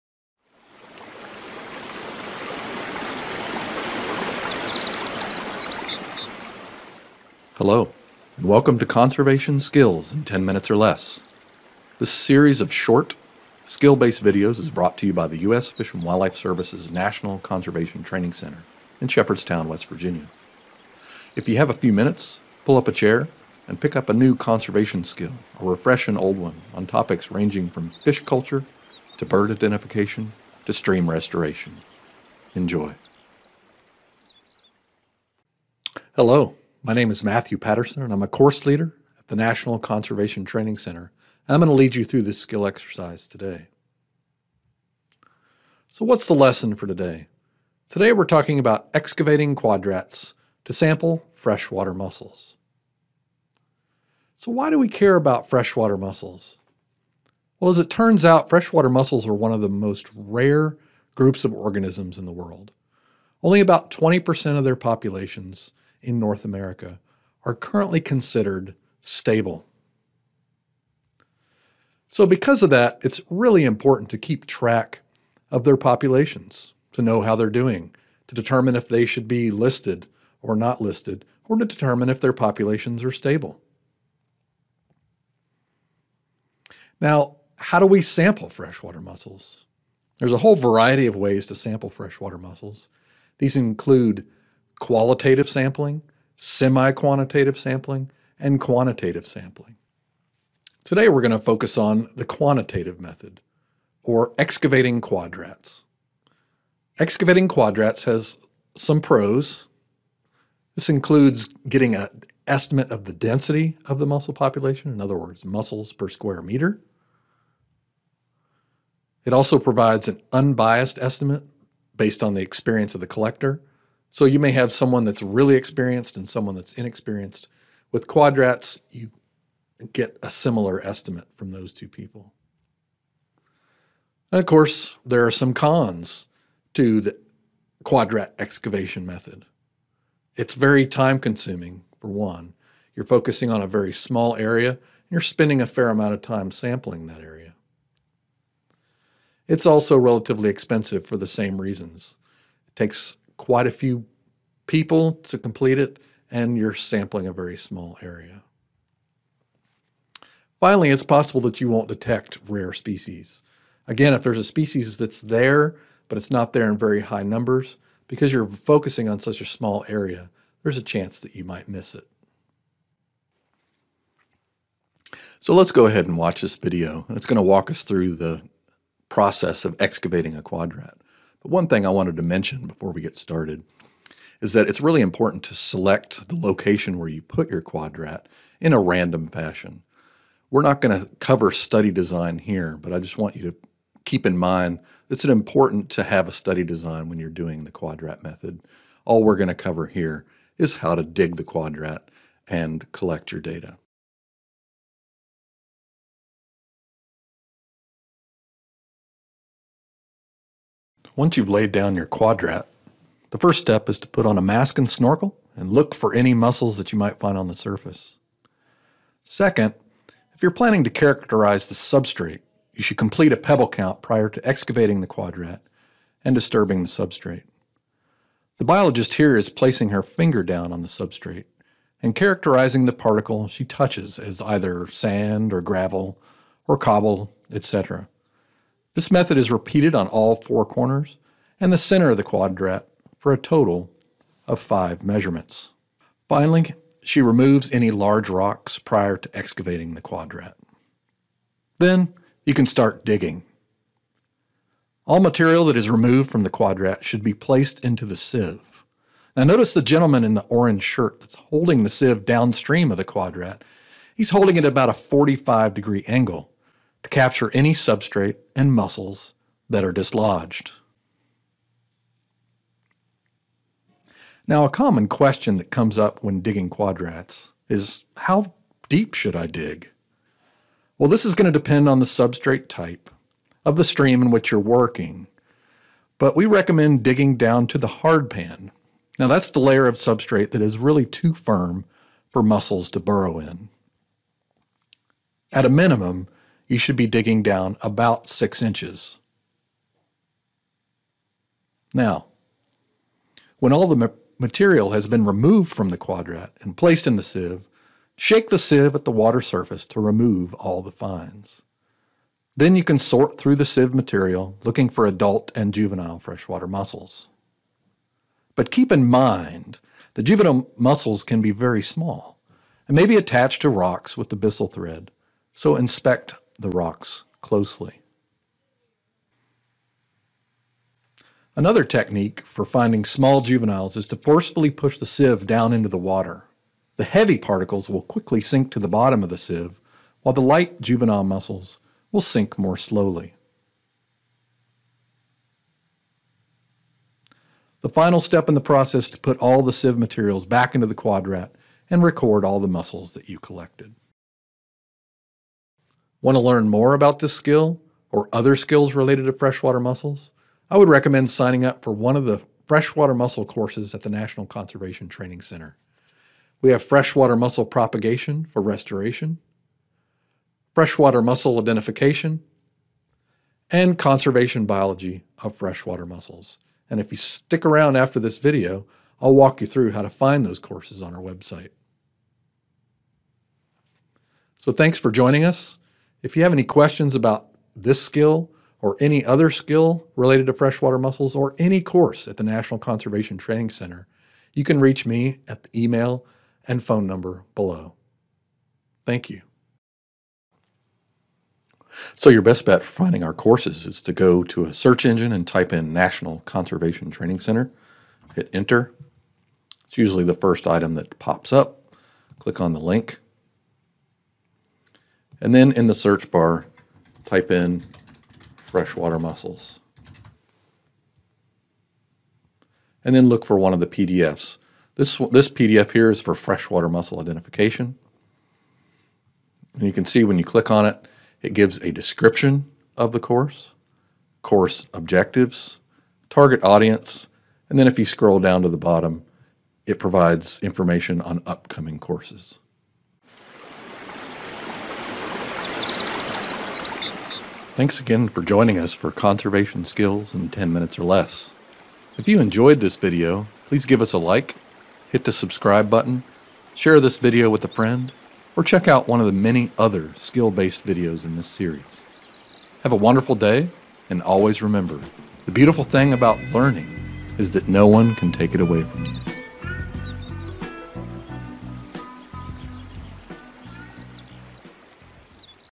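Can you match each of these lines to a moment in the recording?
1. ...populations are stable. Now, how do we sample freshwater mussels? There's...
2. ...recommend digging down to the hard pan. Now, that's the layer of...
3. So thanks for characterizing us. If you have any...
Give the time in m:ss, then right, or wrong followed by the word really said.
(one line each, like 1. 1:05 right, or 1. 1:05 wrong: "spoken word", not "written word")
1. 1:22 right
2. 4:46 right
3. 6:24 wrong: "joining", not "characterizing".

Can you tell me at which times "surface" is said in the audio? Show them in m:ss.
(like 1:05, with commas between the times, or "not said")
3:37, 5:09.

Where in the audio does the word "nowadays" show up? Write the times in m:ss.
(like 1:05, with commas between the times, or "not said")
not said.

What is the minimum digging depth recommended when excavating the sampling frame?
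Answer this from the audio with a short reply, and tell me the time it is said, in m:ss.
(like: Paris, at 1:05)
6 inches, at 4:58.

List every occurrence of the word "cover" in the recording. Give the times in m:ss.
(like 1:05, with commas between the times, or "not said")
3:11, 3:19.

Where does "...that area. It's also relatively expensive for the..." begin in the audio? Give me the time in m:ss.
2:27.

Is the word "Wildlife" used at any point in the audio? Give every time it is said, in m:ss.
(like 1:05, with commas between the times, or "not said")
0:16.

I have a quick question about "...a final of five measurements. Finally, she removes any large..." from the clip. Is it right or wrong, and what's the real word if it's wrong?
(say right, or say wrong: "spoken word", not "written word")
wrong: "total", not "final".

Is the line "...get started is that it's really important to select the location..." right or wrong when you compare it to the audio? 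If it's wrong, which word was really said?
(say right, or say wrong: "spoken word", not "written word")
right.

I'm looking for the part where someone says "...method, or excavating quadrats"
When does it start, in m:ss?
1:42.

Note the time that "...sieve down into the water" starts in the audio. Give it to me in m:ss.
5:35.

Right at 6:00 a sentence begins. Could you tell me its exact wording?
I would recommend signing up for one of the freshwater mussel courses at the National Conservation Training Center.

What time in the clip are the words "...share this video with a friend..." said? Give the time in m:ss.
7:36.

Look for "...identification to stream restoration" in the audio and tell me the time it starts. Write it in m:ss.
0:29.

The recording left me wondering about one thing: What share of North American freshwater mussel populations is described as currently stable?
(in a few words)
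20%.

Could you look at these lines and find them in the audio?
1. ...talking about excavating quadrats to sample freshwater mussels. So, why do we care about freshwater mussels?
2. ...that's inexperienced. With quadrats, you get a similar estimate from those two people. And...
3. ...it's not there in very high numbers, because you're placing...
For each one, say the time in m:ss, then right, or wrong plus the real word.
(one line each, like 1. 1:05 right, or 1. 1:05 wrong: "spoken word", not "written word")
1. 0:48 right
2. 2:06 right
3. 2:46 wrong: "focusing", not "placing".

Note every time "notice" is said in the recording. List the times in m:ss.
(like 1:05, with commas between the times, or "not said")
4:19.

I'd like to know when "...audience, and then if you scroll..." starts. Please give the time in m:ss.
7:16.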